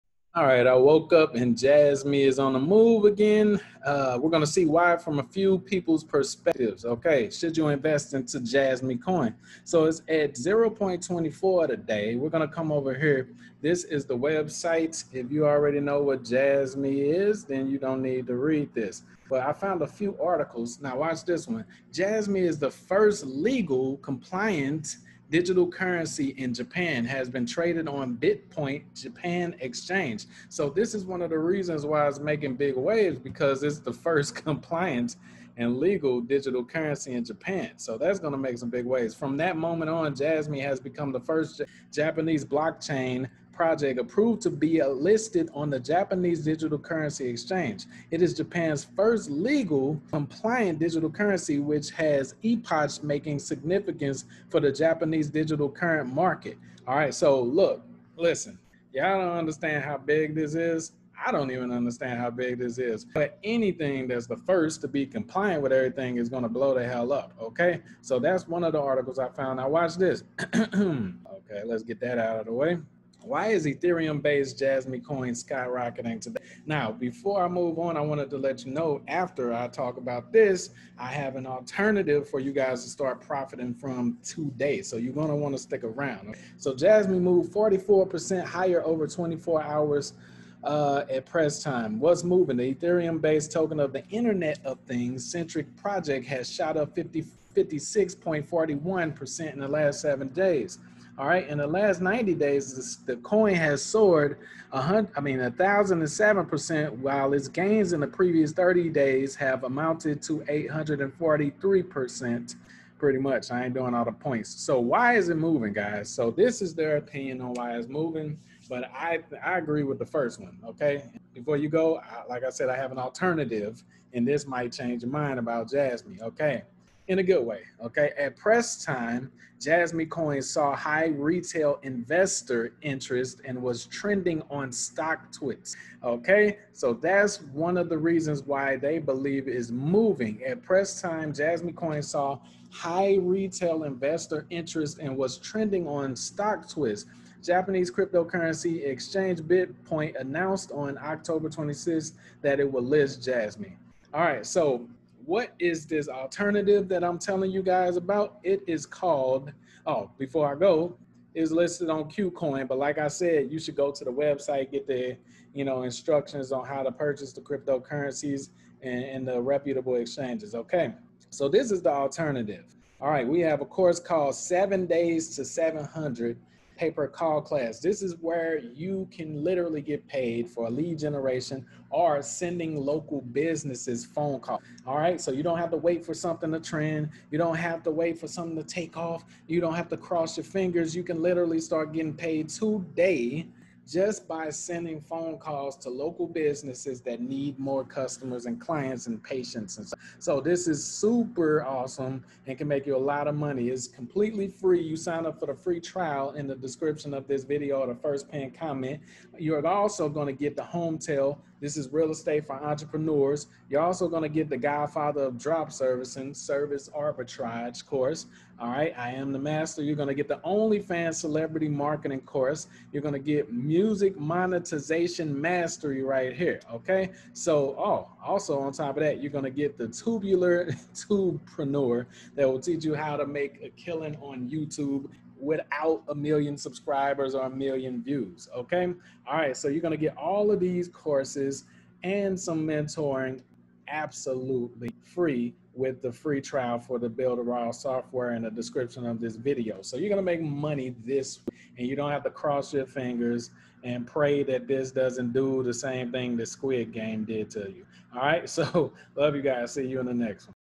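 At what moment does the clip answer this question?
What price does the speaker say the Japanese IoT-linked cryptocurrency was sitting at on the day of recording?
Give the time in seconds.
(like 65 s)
10 s.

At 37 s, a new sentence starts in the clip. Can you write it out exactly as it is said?
So that's going to make some big waves.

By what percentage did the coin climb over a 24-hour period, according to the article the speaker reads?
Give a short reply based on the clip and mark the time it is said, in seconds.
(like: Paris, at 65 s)
44%, at 87 s.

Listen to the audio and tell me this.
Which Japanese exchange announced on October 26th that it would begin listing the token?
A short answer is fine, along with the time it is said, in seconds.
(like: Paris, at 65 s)
BitPoint, at 149 s.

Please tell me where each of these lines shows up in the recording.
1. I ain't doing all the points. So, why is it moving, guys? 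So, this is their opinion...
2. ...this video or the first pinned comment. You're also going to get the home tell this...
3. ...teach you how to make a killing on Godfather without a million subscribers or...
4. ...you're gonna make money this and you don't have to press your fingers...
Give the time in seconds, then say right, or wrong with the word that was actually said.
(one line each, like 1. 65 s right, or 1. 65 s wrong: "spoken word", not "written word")
1. 113 s right
2. 207 s right
3. 232 s wrong: "YouTube", not "Godfather"
4. 249 s wrong: "cross", not "press".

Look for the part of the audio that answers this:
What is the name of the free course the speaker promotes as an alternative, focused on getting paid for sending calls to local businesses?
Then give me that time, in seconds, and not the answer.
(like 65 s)
174 s.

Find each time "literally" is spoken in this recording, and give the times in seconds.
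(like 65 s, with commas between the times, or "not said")
179 s, 191 s.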